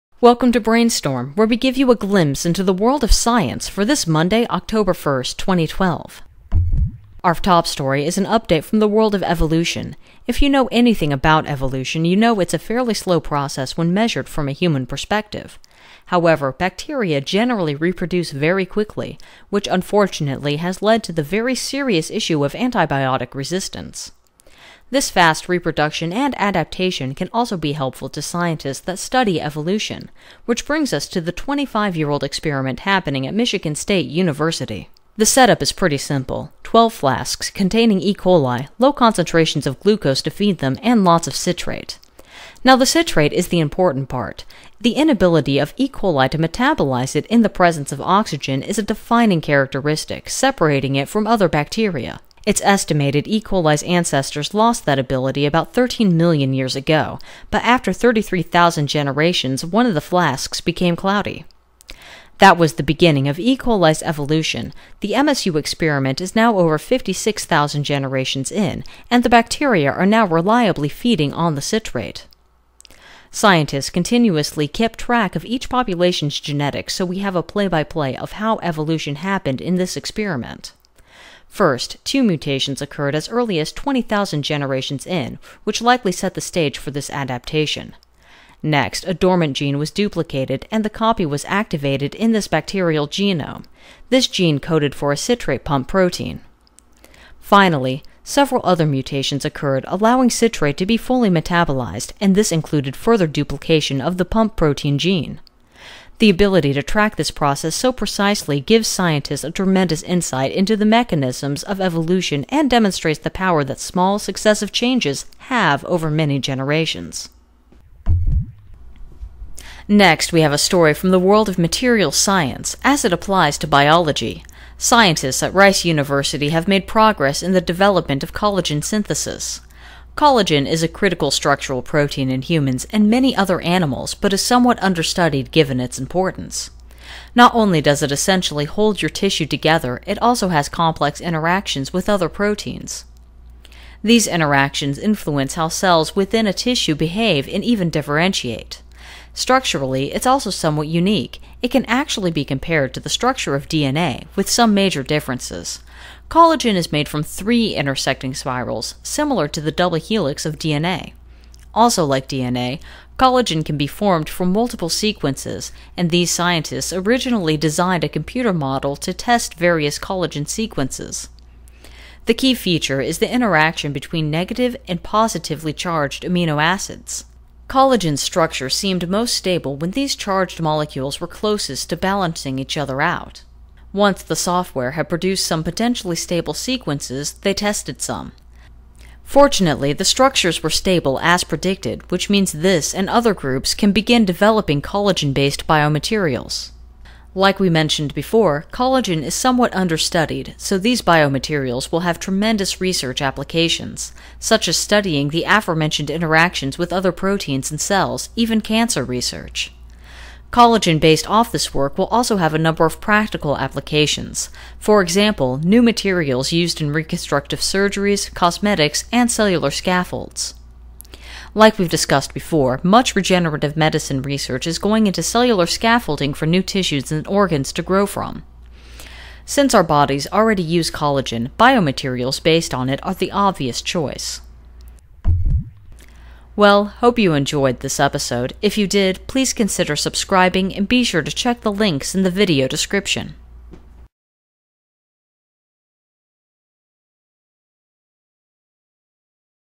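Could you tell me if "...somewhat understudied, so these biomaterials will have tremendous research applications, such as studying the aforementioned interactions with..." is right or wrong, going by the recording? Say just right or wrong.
right.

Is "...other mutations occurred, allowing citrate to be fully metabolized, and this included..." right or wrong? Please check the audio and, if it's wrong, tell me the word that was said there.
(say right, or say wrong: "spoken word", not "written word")
right.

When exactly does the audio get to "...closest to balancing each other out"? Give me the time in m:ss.
3:01.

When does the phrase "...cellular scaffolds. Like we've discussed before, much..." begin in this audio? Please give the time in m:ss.
3:39.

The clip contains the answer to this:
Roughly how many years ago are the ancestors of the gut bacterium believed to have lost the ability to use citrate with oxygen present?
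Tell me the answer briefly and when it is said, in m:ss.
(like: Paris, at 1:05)
13 million years, at 0:55.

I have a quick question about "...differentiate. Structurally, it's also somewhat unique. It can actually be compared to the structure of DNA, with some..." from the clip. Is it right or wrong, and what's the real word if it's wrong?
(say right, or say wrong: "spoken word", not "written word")
right.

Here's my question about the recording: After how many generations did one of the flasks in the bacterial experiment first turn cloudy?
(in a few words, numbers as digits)
33,000.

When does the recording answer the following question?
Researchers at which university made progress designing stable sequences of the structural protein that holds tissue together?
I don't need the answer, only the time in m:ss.
2:05.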